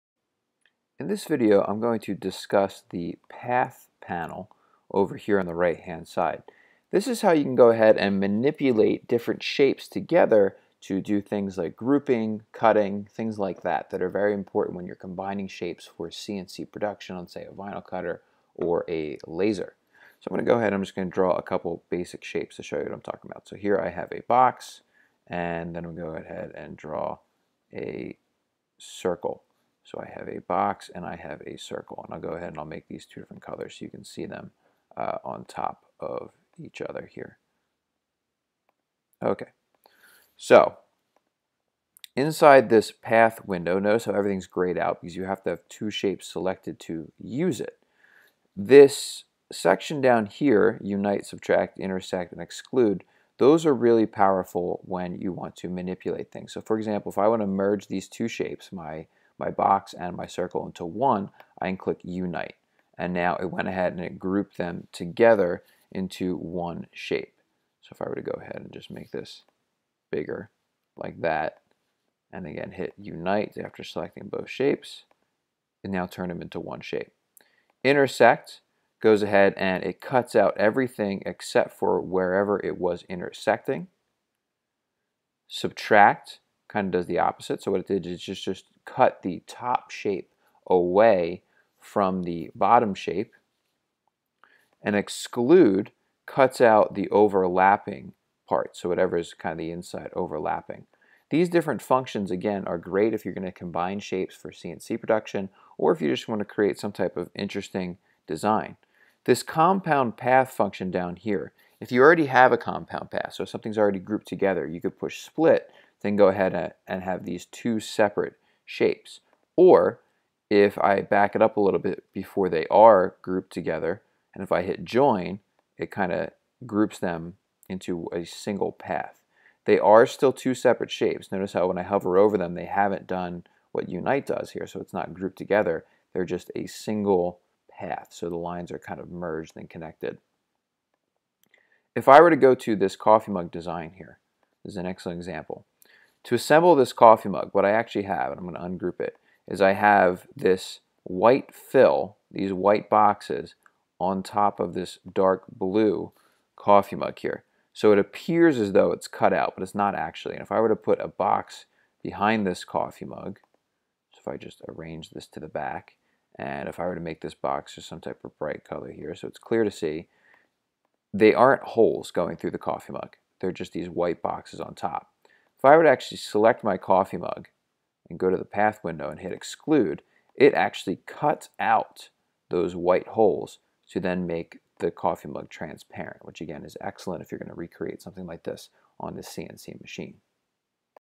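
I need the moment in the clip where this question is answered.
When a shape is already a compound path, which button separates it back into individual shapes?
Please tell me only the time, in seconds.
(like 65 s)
115 s.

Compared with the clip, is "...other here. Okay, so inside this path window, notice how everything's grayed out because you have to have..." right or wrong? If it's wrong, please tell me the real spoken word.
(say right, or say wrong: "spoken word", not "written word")
right.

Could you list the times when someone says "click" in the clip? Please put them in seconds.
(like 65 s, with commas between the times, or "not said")
61 s.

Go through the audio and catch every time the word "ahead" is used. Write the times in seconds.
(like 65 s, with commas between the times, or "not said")
7 s, 20 s, 26 s, 32 s, 63 s, 68 s, 79 s, 116 s.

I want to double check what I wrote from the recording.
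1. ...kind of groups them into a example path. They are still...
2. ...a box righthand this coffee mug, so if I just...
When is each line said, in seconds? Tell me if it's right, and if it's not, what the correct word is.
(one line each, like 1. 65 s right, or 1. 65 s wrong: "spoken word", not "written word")
1. 125 s wrong: "single", not "example"
2. 161 s wrong: "behind", not "righthand".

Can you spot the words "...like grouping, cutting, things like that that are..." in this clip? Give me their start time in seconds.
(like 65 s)
11 s.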